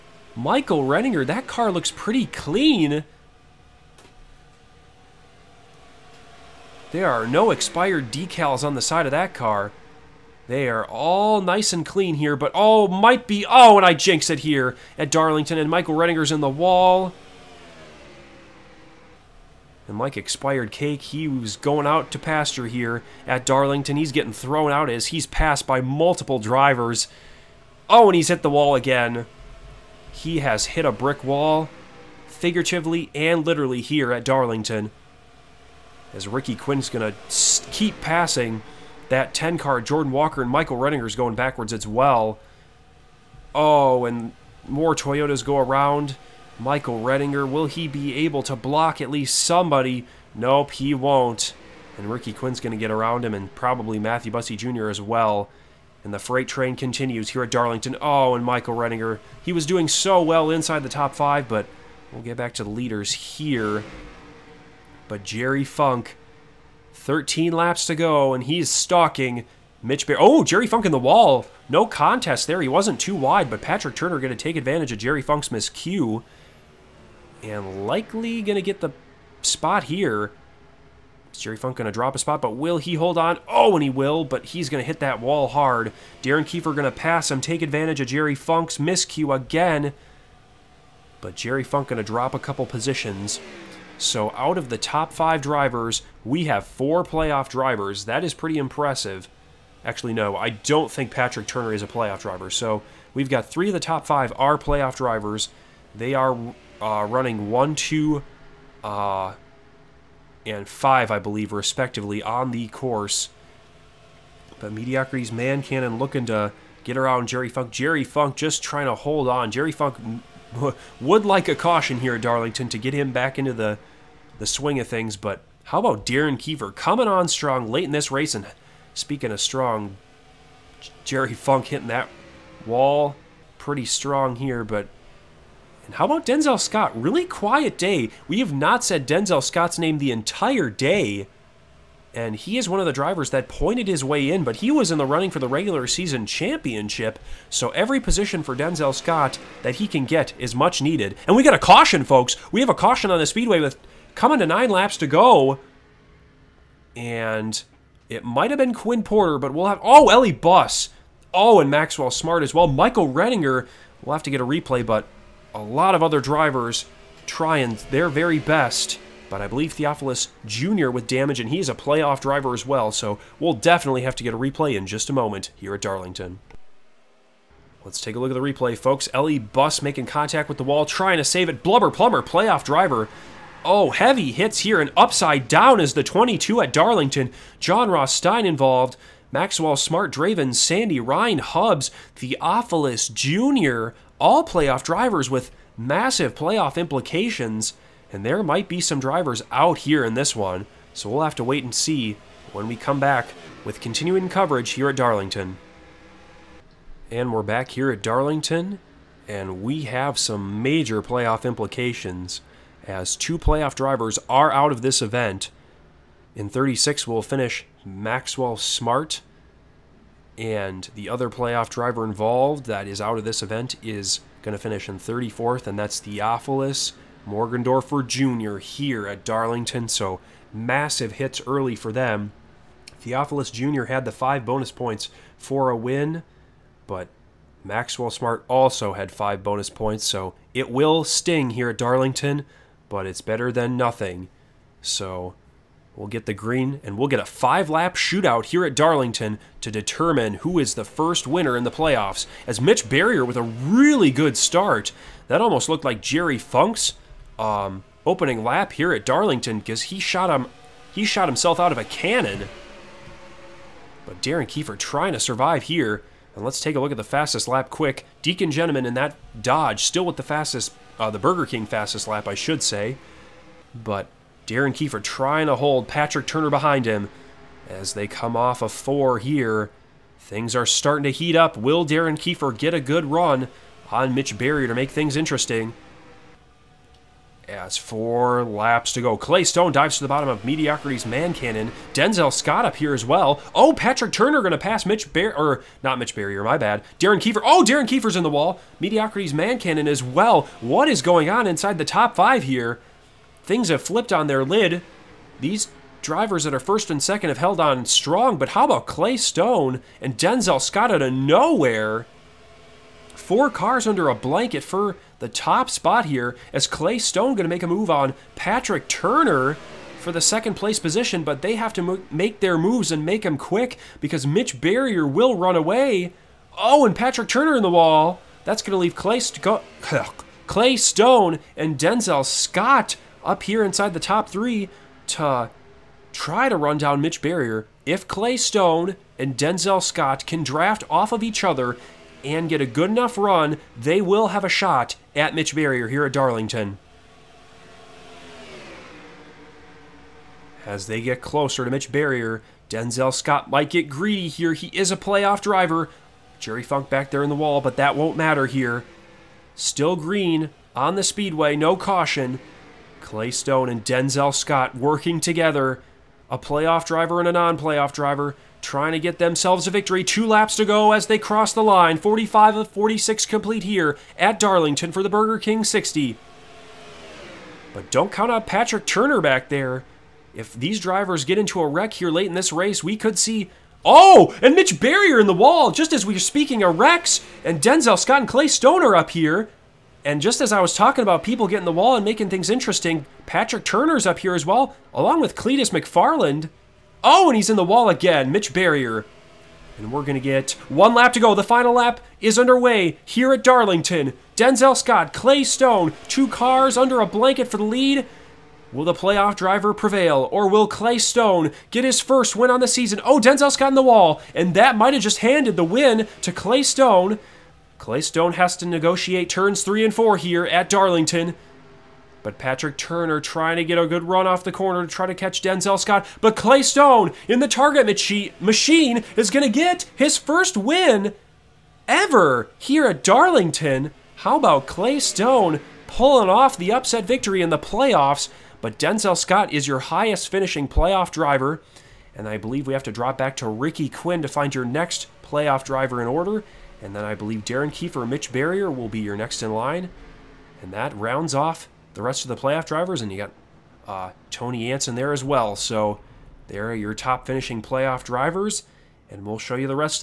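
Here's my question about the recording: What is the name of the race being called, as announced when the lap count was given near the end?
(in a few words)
Burger King 60.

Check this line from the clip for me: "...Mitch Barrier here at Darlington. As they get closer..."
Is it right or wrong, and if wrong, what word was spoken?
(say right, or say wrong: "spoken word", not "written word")
right.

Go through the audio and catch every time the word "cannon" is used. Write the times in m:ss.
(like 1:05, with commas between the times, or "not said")
1:55, 4:21, 4:51, 4:59.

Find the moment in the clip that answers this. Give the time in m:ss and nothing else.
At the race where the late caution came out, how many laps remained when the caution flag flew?
2:34.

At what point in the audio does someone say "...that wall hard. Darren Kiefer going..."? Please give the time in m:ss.
1:24.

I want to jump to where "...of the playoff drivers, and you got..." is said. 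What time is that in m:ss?
7:32.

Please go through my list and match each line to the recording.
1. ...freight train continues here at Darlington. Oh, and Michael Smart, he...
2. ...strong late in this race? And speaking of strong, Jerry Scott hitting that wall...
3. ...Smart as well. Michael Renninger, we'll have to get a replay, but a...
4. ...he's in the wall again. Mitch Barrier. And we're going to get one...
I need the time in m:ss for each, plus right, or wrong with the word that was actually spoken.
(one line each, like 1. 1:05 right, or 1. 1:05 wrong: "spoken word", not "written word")
1. 0:56 wrong: "Redinger", not "Smart"
2. 2:07 wrong: "Funk", not "Scott"
3. 2:42 right
4. 6:37 right.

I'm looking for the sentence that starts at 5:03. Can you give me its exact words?
Things have flipped on their lid.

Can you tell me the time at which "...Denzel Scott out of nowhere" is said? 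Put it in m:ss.
5:10.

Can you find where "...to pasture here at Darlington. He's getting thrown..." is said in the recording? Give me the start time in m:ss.
0:22.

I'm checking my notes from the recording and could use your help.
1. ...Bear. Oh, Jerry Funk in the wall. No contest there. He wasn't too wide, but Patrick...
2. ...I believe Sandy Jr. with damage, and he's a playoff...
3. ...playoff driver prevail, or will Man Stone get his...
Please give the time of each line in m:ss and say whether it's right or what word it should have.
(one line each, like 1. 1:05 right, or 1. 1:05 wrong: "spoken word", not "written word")
1. 1:10 right
2. 2:49 wrong: "Theophilus", not "Sandy"
3. 6:48 wrong: "Clay", not "Man".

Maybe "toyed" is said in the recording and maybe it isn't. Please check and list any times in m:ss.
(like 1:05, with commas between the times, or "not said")
not said.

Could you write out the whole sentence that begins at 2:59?
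Ellie Bus making contact with the wall, trying to save it.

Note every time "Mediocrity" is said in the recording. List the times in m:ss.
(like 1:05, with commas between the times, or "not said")
1:54, 4:50, 4:58.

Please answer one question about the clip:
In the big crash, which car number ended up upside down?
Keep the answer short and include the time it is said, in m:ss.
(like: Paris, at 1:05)
22, at 3:06.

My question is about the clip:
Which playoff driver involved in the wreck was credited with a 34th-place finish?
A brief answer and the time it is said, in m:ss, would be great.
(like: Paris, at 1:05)
Theophilus Morgendorfer Jr., at 3:45.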